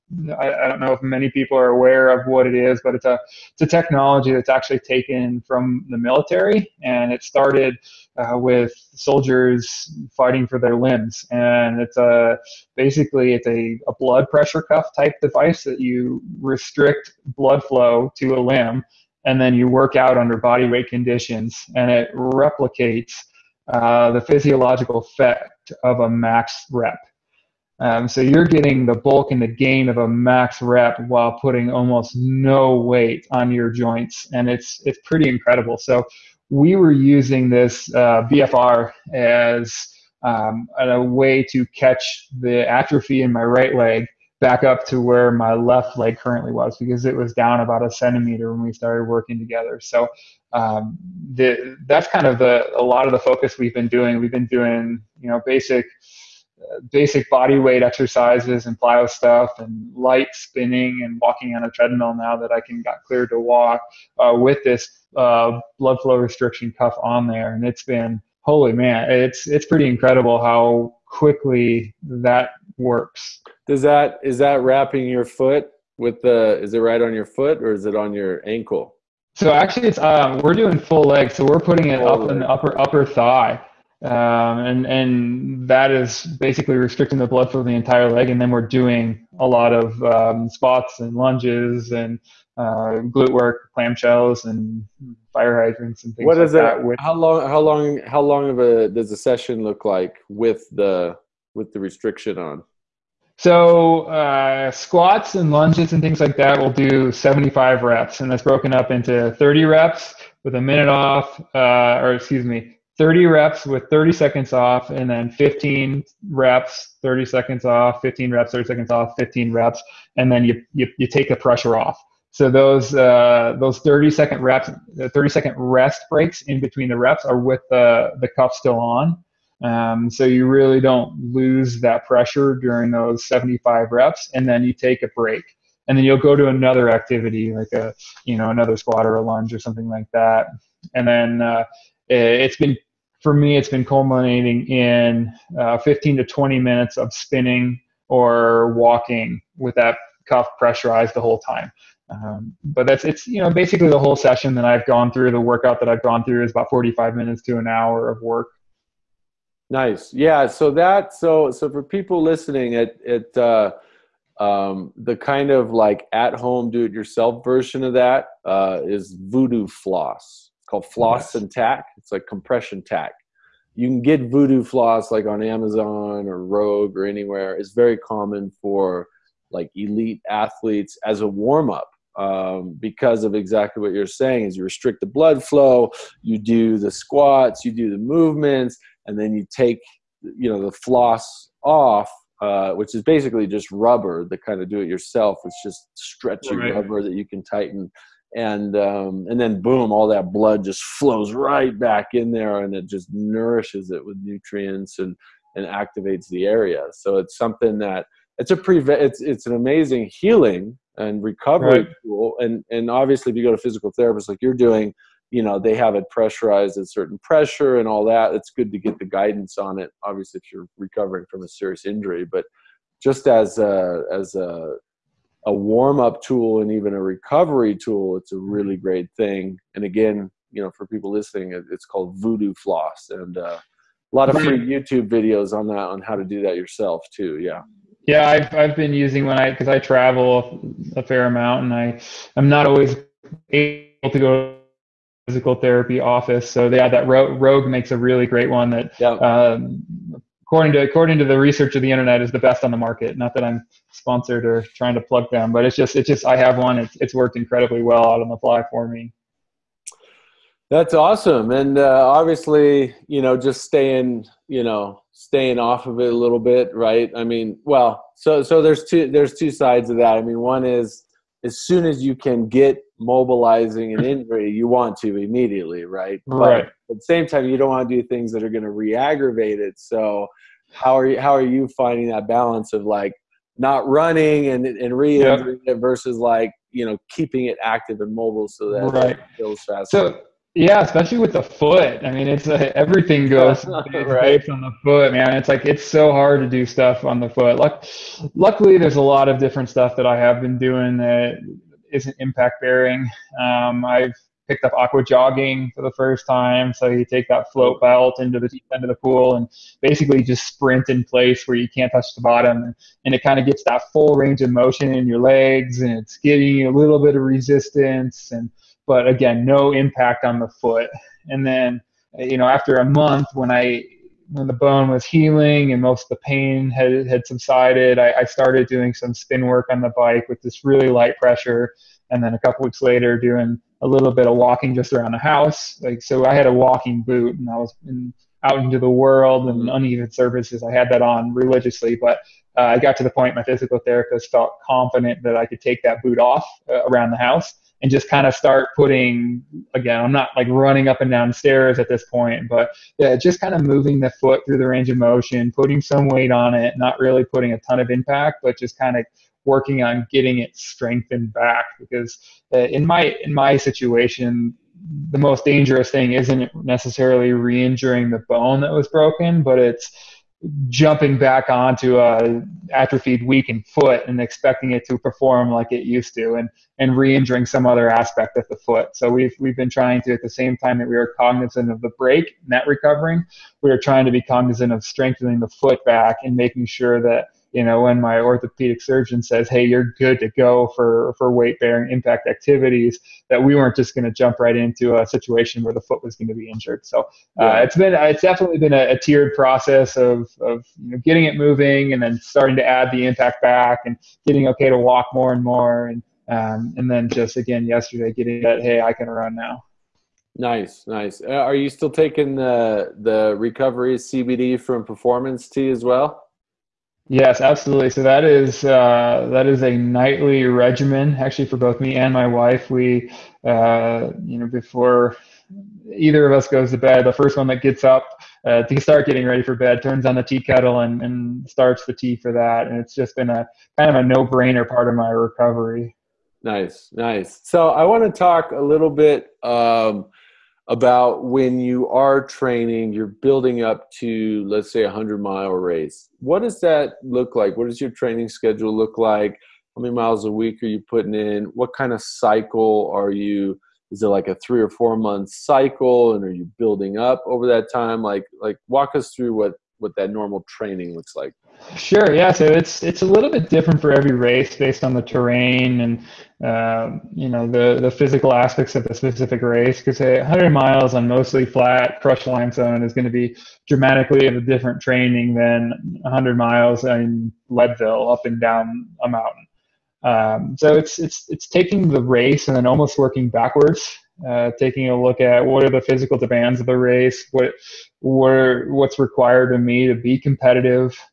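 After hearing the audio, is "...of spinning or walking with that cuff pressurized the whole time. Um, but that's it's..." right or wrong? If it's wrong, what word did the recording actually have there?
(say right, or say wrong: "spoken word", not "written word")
right.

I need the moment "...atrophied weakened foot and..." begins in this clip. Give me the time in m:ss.
6:12.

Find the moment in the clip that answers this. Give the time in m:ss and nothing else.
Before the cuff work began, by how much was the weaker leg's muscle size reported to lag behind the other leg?
0:47.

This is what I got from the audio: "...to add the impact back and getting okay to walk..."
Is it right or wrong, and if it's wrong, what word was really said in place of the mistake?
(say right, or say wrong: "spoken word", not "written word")
right.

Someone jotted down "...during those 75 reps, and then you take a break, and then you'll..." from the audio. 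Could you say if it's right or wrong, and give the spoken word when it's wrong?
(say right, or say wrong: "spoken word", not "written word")
right.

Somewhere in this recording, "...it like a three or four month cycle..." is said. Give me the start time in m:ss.
7:34.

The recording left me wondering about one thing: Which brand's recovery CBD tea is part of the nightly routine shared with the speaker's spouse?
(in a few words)
Performance T.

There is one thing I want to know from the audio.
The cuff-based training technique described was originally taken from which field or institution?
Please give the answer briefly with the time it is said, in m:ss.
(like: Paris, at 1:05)
The military, at 0:05.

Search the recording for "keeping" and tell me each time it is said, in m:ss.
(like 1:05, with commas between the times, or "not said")
4:47.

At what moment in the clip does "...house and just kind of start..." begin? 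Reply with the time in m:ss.
5:47.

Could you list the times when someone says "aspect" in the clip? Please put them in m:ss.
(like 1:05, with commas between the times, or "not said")
6:17, 7:48.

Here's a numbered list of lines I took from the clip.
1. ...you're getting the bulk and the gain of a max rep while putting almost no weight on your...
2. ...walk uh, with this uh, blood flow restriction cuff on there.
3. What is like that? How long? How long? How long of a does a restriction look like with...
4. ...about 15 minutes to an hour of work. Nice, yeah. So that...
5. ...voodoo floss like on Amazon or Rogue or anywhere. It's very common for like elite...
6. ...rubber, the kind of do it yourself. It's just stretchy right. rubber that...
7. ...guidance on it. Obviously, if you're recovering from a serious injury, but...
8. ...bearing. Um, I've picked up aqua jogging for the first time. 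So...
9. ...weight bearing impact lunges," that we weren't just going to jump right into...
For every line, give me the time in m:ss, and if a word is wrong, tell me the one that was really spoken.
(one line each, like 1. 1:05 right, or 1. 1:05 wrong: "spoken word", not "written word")
1. 0:28 right
2. 1:03 right
3. 1:36 wrong: "session", not "restriction"
4. 2:36 wrong: "45", not "15"
5. 2:54 right
6. 3:13 right
7. 3:39 right
8. 5:02 right
9. 6:31 wrong: "activities", not "lunges".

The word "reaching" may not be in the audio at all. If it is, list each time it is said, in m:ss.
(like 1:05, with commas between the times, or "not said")
not said.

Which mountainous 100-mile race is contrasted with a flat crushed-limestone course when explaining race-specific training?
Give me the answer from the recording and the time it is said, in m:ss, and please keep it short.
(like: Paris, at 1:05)
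Leadville, at 7:57.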